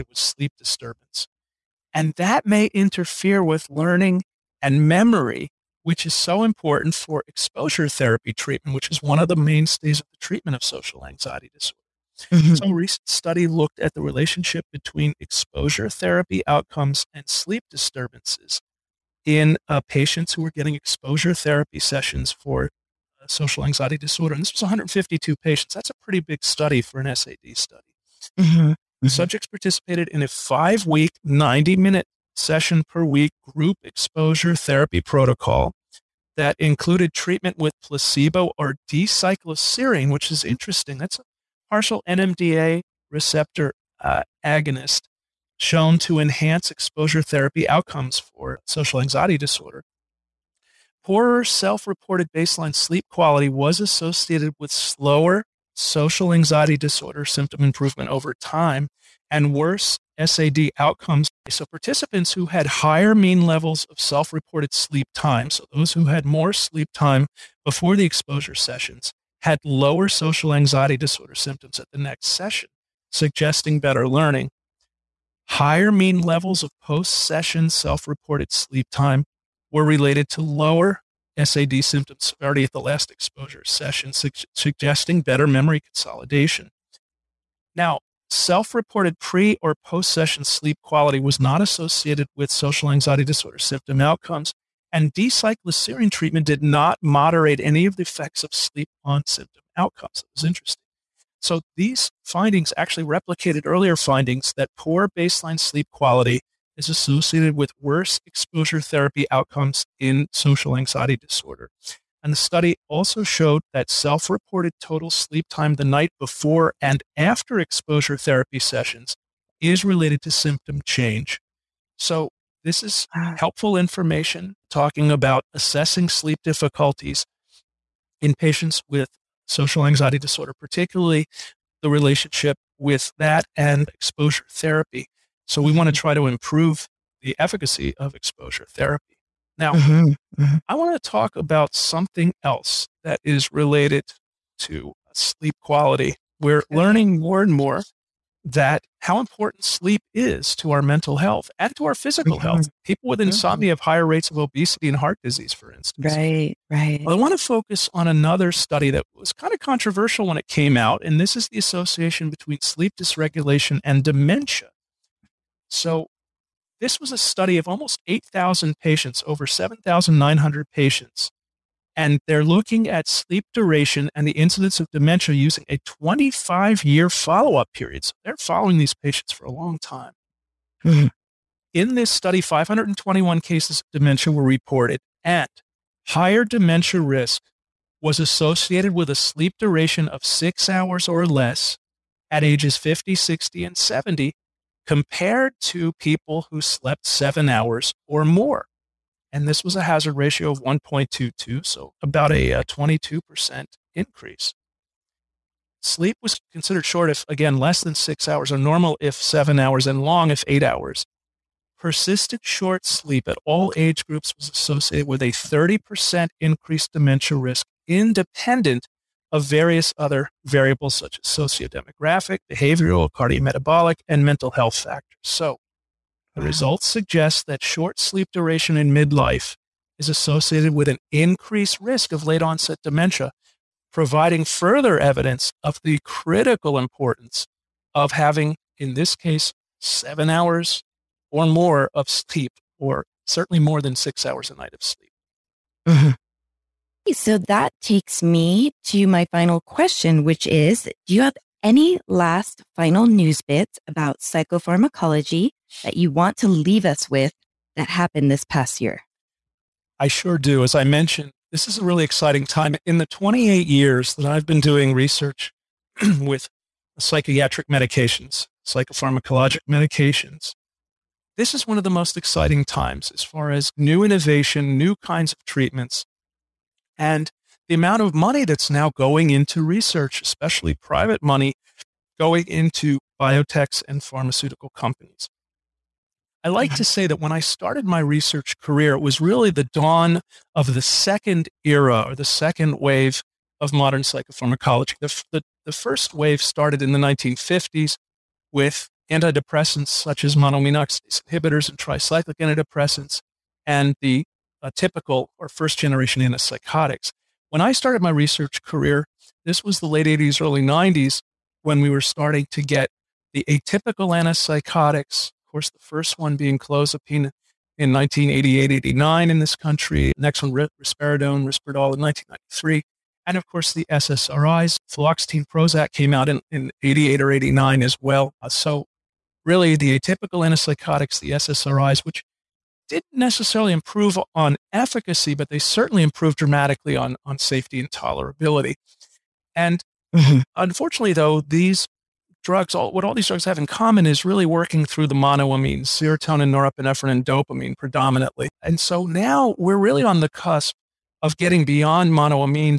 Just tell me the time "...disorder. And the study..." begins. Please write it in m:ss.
1:51.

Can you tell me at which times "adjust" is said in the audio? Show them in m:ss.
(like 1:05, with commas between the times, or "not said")
not said.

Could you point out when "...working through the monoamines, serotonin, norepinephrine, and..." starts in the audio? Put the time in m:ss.
5:44.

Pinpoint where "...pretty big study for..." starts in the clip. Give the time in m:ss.
0:26.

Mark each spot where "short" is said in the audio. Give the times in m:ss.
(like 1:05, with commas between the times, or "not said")
3:26, 3:32, 3:47.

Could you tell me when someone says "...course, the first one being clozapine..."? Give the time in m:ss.
5:15.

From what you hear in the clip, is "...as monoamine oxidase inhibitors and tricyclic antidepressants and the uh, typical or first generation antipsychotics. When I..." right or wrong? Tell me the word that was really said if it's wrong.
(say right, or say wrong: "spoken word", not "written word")
right.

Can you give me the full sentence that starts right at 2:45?
So this was a study of almost 8,000 patients, over 7,900 patients.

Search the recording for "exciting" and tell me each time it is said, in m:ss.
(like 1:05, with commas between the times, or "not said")
4:22, 4:32.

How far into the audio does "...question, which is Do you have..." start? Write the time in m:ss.
4:09.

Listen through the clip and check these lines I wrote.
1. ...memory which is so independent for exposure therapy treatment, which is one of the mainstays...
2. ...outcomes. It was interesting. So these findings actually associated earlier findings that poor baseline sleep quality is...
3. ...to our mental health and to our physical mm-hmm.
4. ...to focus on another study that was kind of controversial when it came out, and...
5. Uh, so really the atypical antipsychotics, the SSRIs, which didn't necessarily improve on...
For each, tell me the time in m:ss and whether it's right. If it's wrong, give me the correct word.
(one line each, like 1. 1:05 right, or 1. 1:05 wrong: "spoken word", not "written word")
1. 0:04 wrong: "important", not "independent"
2. 1:39 wrong: "replicated", not "associated"
3. 2:30 right
4. 2:37 right
5. 5:28 right.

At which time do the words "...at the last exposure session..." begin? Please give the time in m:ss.
1:22.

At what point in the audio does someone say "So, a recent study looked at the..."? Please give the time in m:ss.
0:12.